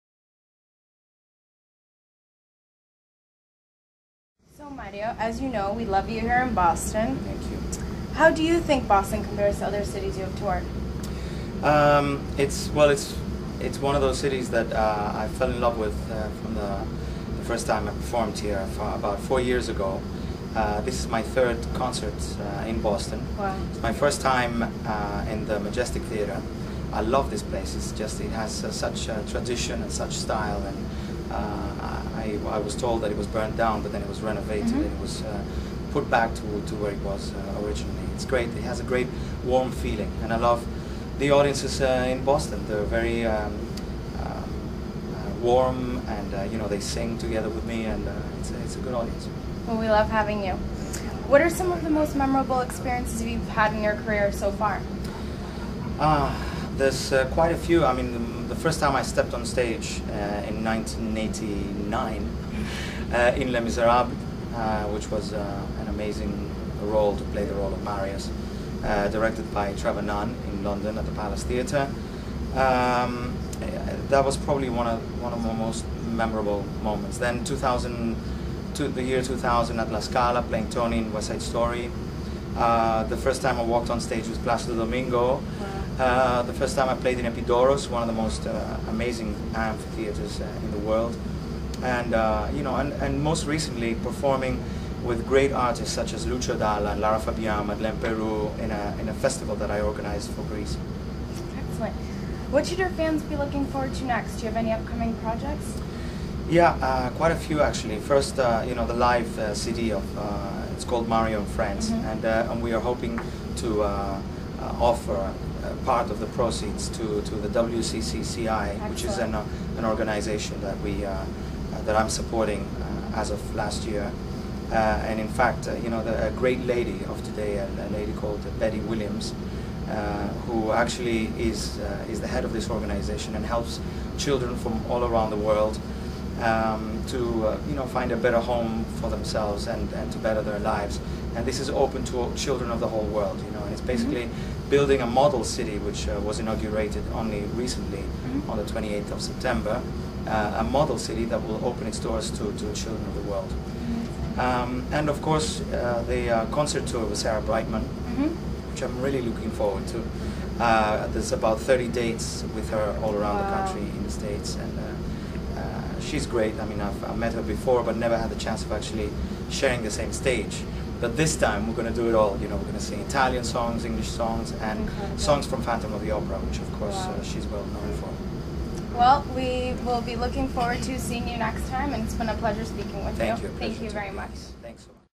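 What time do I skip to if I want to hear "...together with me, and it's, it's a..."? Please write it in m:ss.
0:47.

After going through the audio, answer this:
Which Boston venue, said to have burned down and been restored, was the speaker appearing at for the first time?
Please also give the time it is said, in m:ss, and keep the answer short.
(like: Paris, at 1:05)
Majestic Theatre, at 0:25.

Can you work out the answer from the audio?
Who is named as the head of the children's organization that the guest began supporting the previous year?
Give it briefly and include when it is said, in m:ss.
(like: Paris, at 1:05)
Betty Williams, at 2:08.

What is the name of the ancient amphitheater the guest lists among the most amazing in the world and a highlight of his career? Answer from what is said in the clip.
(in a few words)
Epidaurus.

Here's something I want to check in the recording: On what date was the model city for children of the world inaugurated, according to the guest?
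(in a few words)
28 September.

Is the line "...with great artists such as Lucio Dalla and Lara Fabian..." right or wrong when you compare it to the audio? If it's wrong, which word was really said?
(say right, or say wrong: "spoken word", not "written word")
right.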